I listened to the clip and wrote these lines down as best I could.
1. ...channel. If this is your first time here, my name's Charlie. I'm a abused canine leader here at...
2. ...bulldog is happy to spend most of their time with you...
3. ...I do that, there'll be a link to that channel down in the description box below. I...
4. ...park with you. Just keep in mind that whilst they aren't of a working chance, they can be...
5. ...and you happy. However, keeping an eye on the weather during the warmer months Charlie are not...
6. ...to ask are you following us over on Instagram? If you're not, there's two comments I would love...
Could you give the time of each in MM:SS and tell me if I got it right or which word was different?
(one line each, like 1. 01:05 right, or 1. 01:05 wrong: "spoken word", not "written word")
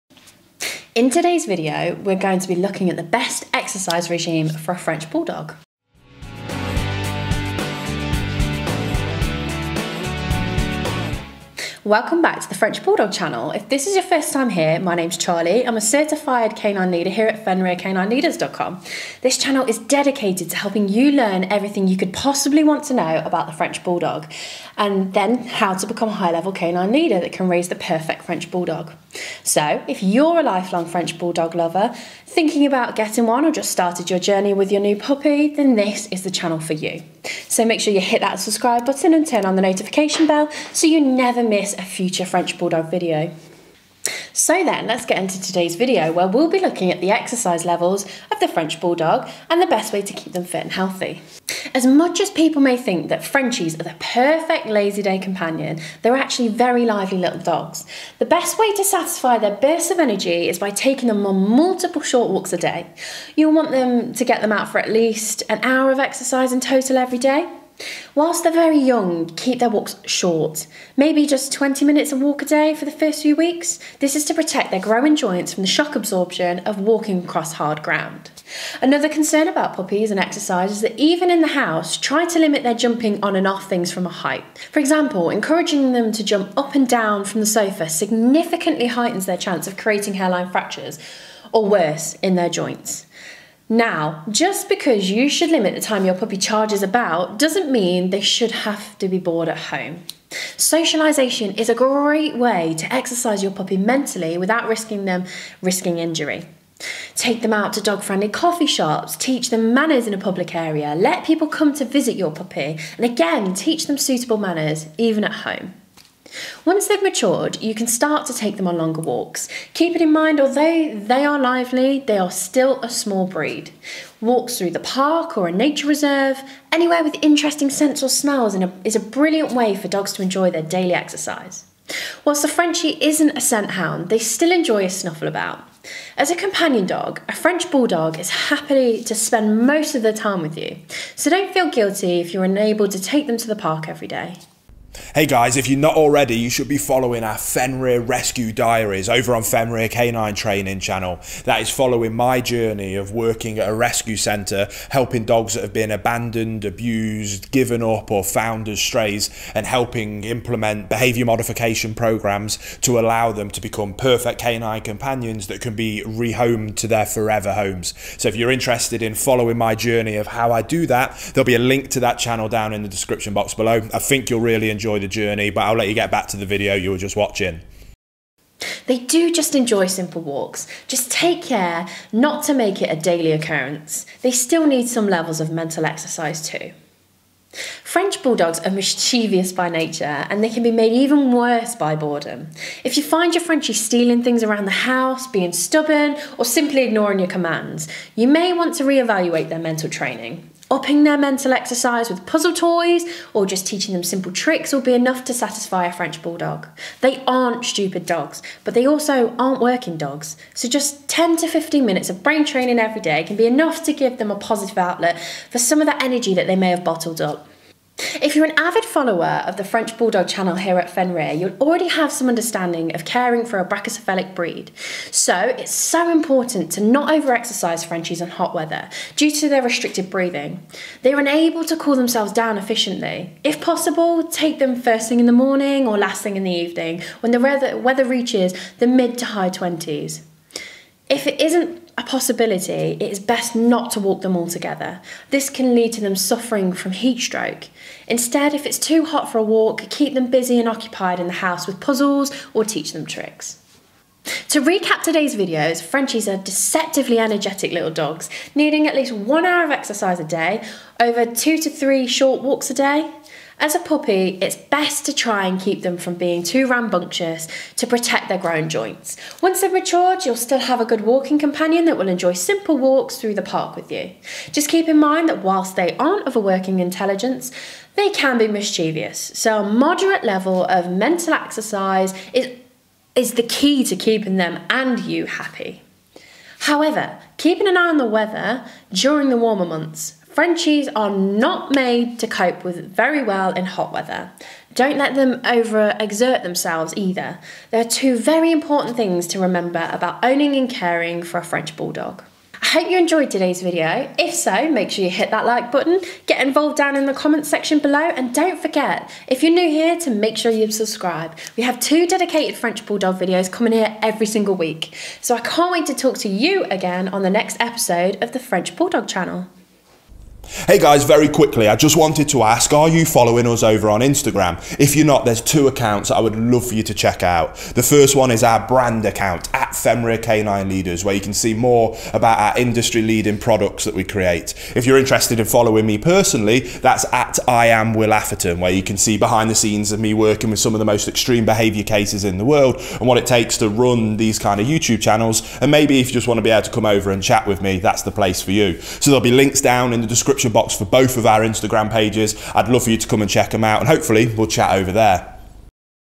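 1. 00:13 wrong: "certified", not "abused"
2. 02:17 right
3. 02:50 right
4. 04:33 wrong: "intelligence", not "chance"
5. 04:44 wrong: "Frenchies", not "Charlie"
6. 05:22 wrong: "accounts", not "comments".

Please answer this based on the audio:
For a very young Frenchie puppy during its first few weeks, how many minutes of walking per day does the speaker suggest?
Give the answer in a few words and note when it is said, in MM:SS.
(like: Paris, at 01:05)
20 minutes, at 01:11.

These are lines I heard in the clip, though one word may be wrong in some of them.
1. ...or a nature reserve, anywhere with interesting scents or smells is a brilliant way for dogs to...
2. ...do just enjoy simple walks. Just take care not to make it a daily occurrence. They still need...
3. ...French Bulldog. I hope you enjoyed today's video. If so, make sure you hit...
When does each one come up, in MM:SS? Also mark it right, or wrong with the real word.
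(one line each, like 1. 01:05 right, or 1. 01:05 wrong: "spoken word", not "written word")
1. 02:05 right
2. 02:58 right
3. 05:01 right.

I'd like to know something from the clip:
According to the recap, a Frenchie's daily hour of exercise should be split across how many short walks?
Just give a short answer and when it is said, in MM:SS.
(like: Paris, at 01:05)
2 to 3, at 04:21.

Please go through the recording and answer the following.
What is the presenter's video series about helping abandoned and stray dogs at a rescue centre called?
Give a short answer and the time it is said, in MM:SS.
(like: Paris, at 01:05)
Fenrir Rescue Diaries, at 02:27.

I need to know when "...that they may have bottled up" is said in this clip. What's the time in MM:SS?
03:36.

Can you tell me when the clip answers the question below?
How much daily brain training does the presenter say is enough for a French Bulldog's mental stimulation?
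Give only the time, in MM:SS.
03:31.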